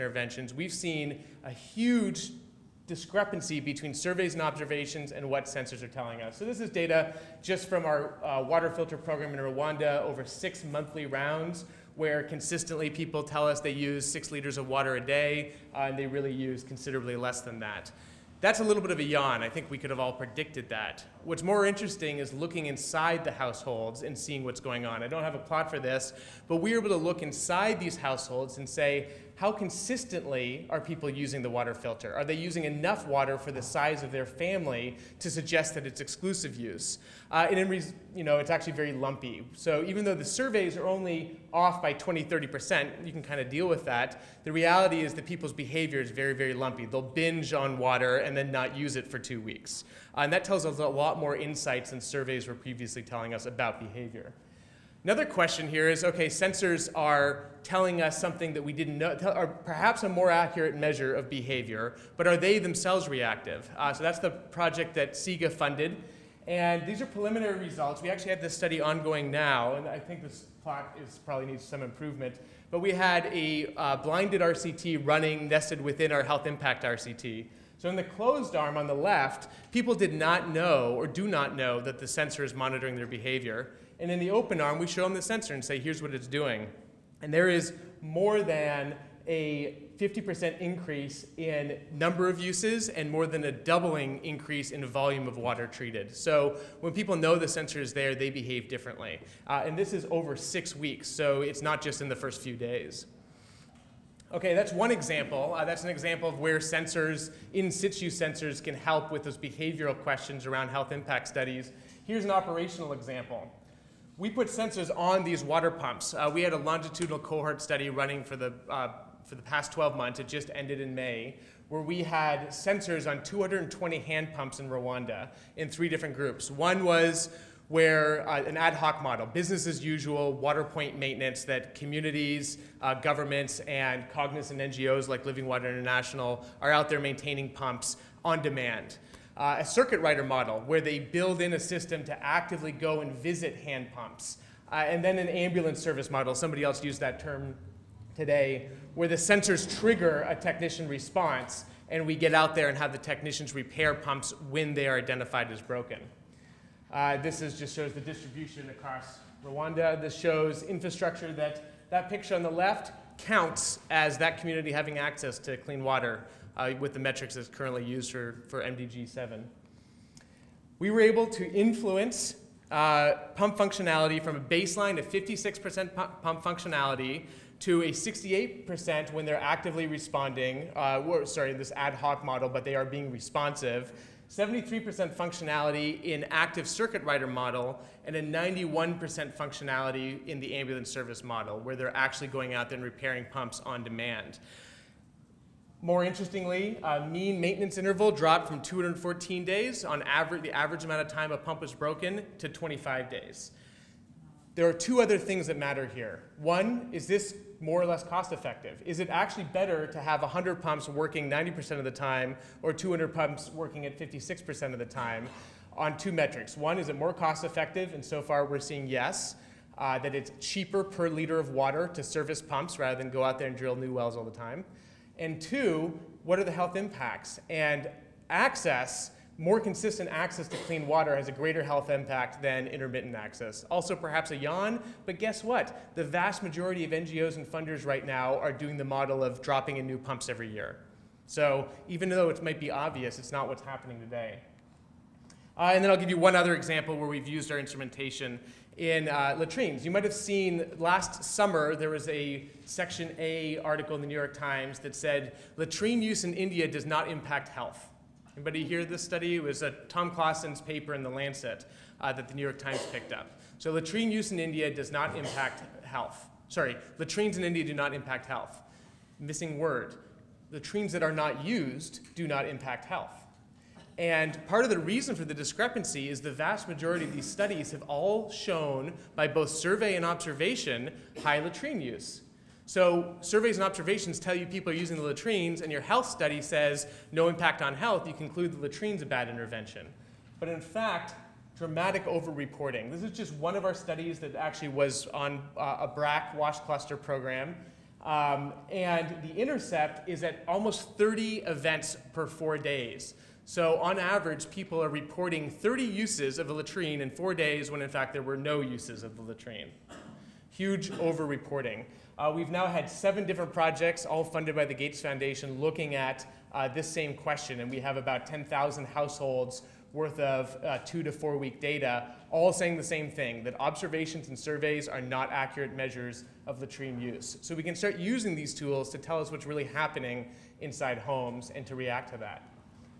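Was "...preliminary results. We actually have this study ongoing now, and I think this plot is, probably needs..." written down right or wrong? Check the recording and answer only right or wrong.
right.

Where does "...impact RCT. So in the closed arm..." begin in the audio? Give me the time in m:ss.
1:16.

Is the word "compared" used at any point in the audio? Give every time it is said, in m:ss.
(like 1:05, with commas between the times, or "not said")
not said.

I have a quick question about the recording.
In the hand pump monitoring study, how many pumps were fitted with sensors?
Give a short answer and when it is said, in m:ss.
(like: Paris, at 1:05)
220, at 2:03.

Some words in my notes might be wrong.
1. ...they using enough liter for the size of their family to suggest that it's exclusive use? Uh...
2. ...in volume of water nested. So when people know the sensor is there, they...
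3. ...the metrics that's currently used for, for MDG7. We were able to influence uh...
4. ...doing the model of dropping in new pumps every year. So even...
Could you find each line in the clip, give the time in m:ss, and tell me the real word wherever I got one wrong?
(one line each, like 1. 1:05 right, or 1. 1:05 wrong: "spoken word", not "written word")
1. 0:32 wrong: "water", not "liter"
2. 1:34 wrong: "treated", not "nested"
3. 2:46 right
4. 3:58 right.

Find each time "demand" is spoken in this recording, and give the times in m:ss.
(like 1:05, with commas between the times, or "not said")
2:18, 3:13.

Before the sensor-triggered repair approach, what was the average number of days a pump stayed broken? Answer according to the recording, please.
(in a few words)
214 days.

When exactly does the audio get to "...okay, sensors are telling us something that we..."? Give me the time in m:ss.
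0:56.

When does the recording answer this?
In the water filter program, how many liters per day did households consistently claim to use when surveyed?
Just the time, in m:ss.
0:14.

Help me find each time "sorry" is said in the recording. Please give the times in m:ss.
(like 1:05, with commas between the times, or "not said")
3:01, 4:26.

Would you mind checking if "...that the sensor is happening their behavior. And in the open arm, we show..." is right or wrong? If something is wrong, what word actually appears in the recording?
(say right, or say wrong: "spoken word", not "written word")
wrong: "monitoring", not "happening".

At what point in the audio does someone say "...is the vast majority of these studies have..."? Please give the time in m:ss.
4:36.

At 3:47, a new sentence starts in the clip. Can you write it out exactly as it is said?
And access, more consistent access to clean water has a greater health impact than intermittent access.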